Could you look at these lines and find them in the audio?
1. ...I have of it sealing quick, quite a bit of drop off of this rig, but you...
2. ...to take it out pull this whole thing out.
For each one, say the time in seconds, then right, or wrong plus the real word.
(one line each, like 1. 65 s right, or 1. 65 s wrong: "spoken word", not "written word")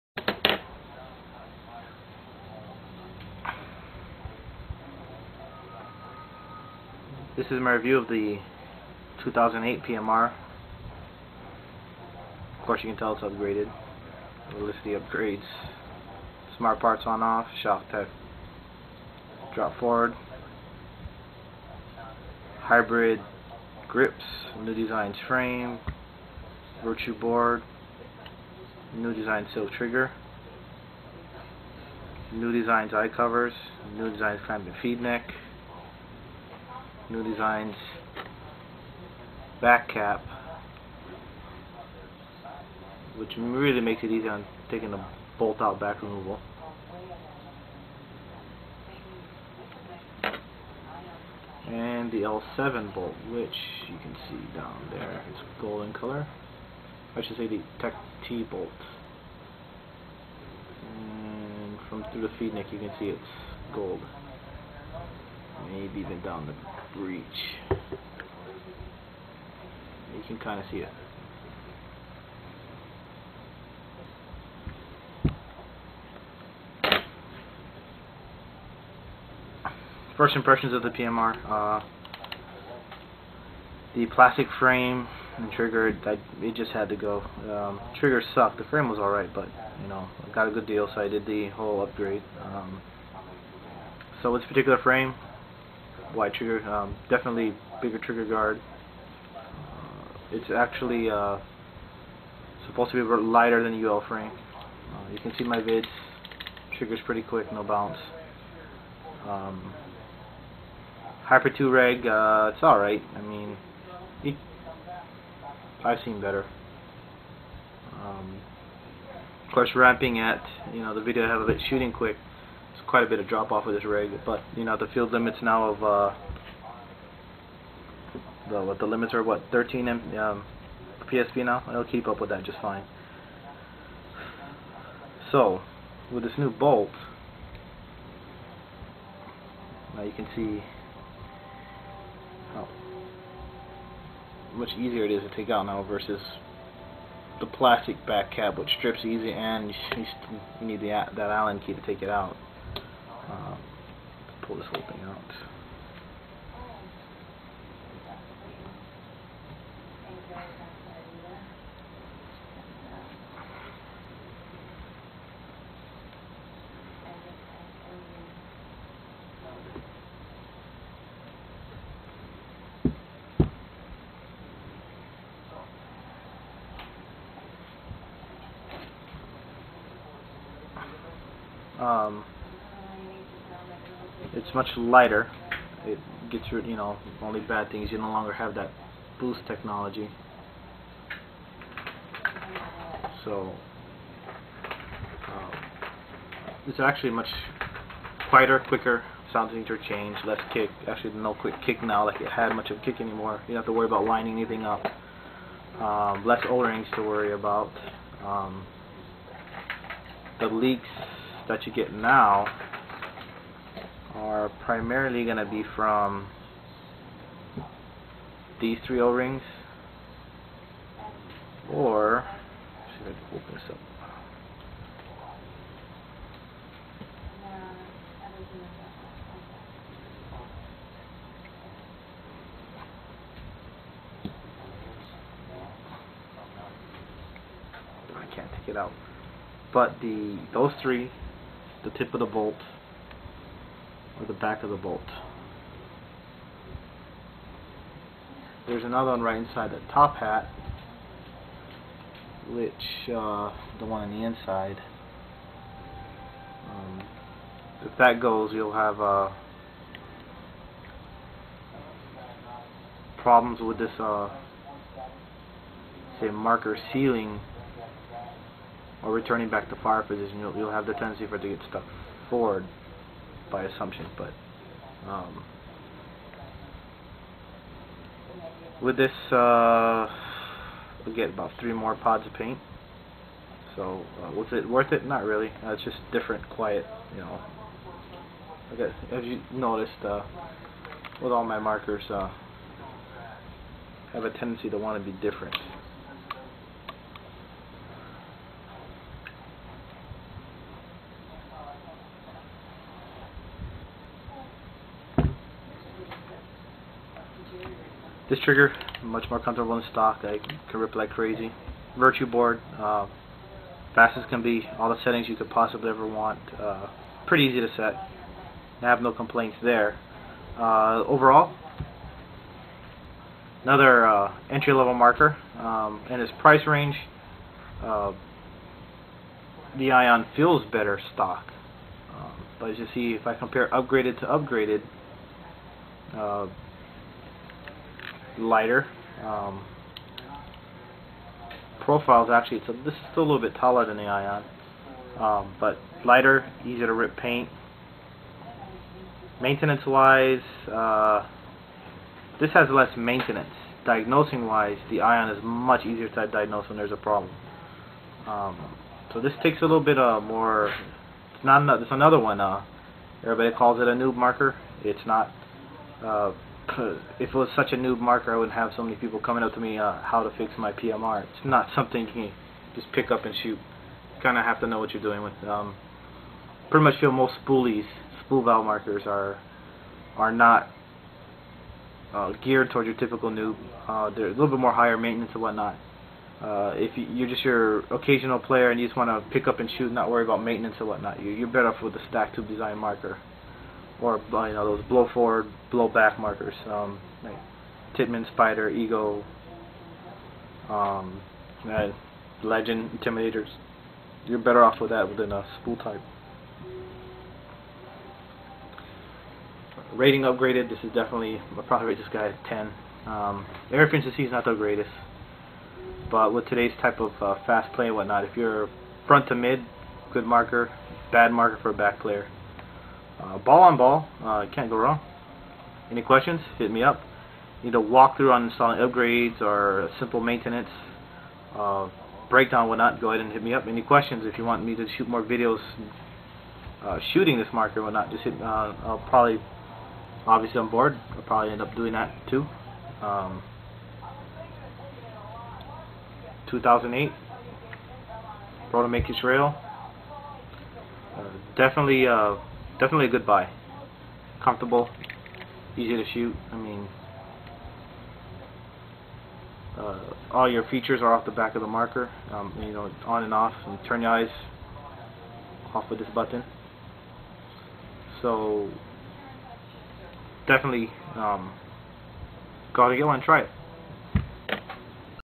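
1. 121 s wrong: "shooting", not "sealing"
2. 151 s right.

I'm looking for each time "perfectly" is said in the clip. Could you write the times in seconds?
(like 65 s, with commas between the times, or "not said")
not said.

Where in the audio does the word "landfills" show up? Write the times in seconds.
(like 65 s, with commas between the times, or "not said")
not said.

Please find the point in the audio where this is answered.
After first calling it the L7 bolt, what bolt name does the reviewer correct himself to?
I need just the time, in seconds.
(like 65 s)
57 s.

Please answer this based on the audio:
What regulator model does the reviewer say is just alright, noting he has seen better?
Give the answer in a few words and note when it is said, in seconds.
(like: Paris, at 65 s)
Hyper 2, at 111 s.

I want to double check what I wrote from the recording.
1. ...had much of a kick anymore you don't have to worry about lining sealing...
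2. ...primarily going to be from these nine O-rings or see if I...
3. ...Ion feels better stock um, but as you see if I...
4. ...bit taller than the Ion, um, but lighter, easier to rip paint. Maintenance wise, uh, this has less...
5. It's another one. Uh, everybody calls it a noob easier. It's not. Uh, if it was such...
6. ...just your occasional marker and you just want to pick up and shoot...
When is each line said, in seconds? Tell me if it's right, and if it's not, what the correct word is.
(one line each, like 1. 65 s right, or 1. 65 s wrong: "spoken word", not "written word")
1. 202 s wrong: "anything", not "sealing"
2. 214 s wrong: "three", not "nine"
3. 329 s right
4. 343 s right
5. 361 s wrong: "marker", not "easier"
6. 387 s wrong: "player", not "marker".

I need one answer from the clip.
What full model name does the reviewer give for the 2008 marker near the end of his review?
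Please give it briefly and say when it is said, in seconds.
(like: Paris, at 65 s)
Proto Matrix Rail, at 448 s.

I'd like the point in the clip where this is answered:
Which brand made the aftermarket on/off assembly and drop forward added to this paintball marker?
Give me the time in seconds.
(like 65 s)
17 s.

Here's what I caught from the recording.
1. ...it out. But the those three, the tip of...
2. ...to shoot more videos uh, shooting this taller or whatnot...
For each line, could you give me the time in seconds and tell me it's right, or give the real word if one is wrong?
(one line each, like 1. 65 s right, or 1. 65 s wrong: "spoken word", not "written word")
1. 238 s right
2. 434 s wrong: "marker", not "taller".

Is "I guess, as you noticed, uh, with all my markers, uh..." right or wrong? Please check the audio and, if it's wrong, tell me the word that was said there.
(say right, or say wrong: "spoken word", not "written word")
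right.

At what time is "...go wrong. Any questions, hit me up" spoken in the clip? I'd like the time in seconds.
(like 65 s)
424 s.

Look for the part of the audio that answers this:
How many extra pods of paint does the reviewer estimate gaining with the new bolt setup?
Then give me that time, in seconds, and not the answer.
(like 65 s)
281 s.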